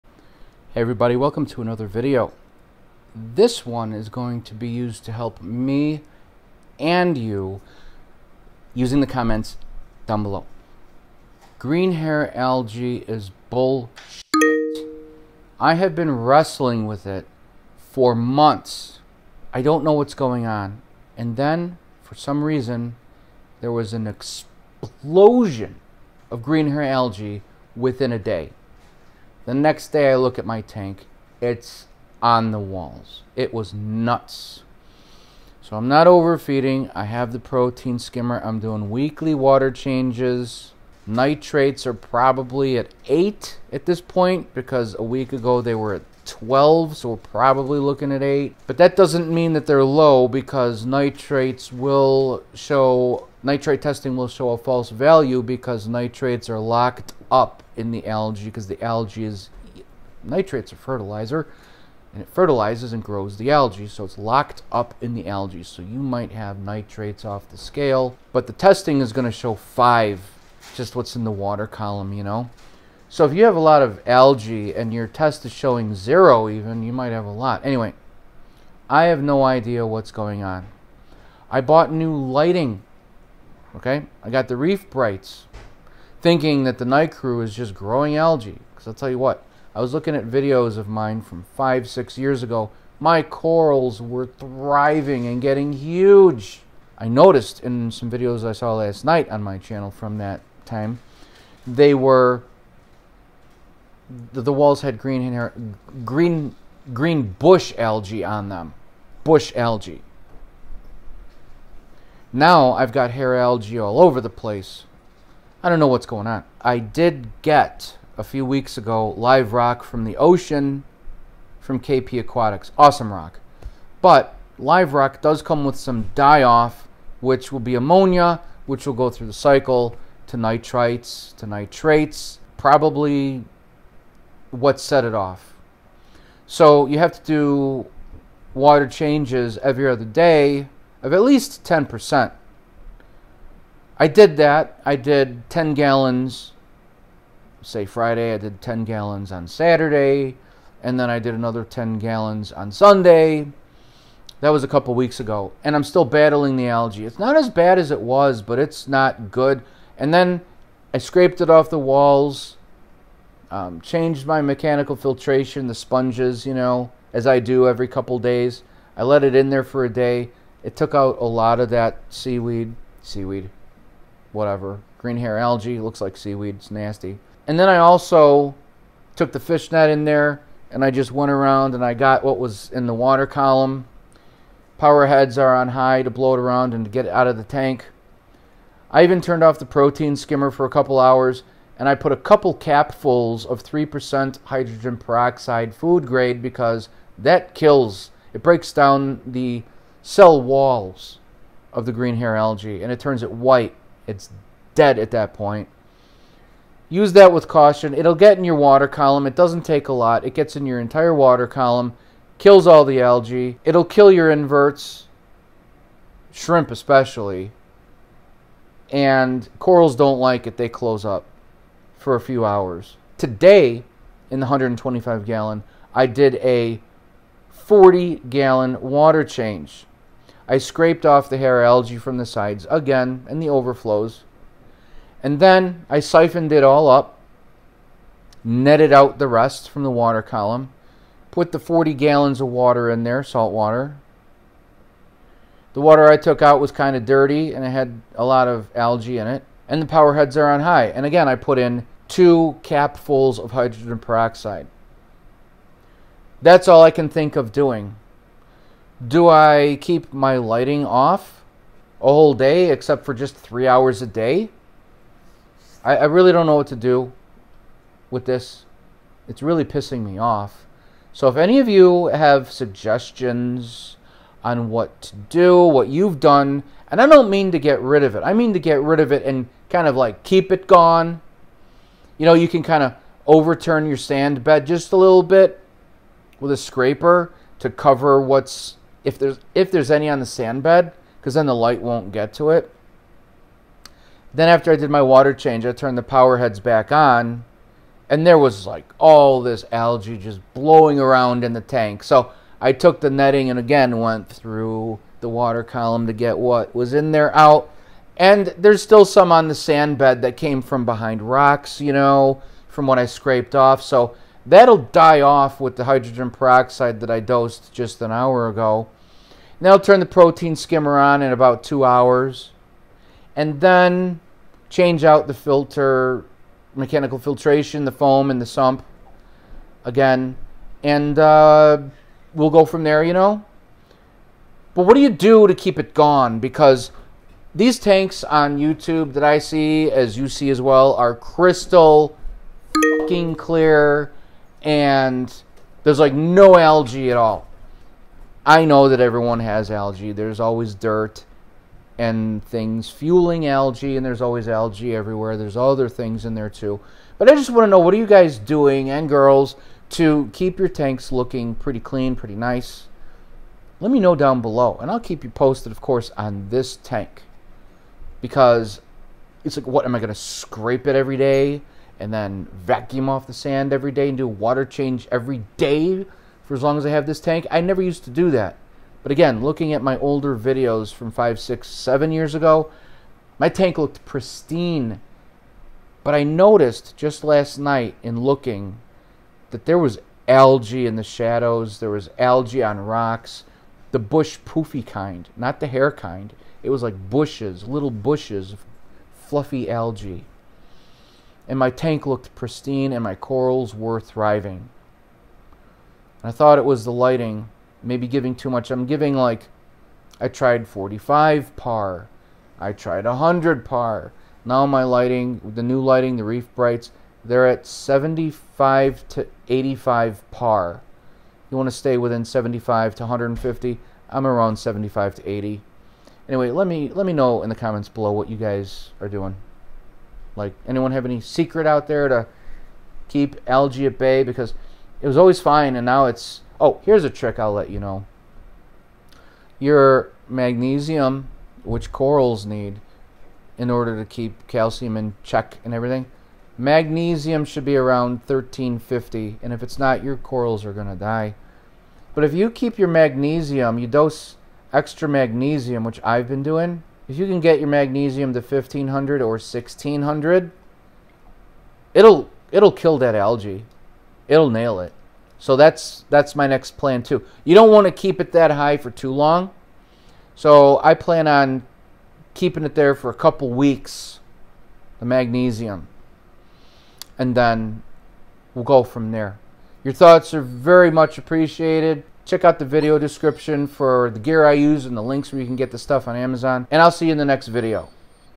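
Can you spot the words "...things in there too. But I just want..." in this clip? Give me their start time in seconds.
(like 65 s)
355 s.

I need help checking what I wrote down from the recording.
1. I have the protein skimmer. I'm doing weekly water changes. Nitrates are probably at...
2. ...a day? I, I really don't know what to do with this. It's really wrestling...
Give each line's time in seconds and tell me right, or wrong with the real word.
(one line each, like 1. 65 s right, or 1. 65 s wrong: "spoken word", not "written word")
1. 36 s right
2. 264 s wrong: "pissing", not "wrestling".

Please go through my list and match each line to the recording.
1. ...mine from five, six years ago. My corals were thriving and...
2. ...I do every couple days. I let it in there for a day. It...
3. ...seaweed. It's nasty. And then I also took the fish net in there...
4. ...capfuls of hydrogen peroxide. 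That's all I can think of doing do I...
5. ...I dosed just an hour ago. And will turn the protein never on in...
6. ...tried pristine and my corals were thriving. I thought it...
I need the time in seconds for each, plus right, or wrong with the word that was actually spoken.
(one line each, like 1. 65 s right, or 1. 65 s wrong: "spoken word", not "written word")
1. 90 s right
2. 167 s right
3. 176 s right
4. 252 s right
5. 317 s wrong: "skimmer", not "never"
6. 402 s wrong: "looked", not "tried".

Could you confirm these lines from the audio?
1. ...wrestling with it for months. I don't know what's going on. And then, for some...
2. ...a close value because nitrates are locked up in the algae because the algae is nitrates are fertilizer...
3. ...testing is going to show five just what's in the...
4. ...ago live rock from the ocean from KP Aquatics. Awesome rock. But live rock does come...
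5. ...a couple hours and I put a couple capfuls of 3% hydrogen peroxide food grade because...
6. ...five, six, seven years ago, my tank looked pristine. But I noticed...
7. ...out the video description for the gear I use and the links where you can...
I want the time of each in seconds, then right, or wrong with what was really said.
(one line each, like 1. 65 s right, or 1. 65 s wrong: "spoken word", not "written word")
1. 16 s right
2. 54 s wrong: "false", not "close"
3. 68 s right
4. 118 s right
5. 190 s right
6. 381 s right
7. 482 s right.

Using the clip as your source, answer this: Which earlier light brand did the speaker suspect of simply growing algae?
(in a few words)
Nicrew.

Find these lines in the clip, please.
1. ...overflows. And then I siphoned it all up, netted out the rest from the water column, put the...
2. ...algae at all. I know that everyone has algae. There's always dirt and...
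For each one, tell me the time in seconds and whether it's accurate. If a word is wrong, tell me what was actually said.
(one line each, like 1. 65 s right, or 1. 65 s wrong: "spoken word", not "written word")
1. 233 s right
2. 346 s right.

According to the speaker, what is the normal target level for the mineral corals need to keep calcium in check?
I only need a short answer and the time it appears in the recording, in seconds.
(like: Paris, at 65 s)
1350, at 448 s.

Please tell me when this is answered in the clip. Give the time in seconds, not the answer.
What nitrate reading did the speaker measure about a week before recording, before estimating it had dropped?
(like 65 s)
46 s.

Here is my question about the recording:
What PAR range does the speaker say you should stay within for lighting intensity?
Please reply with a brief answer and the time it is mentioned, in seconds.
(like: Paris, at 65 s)
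75 to 150, at 422 s.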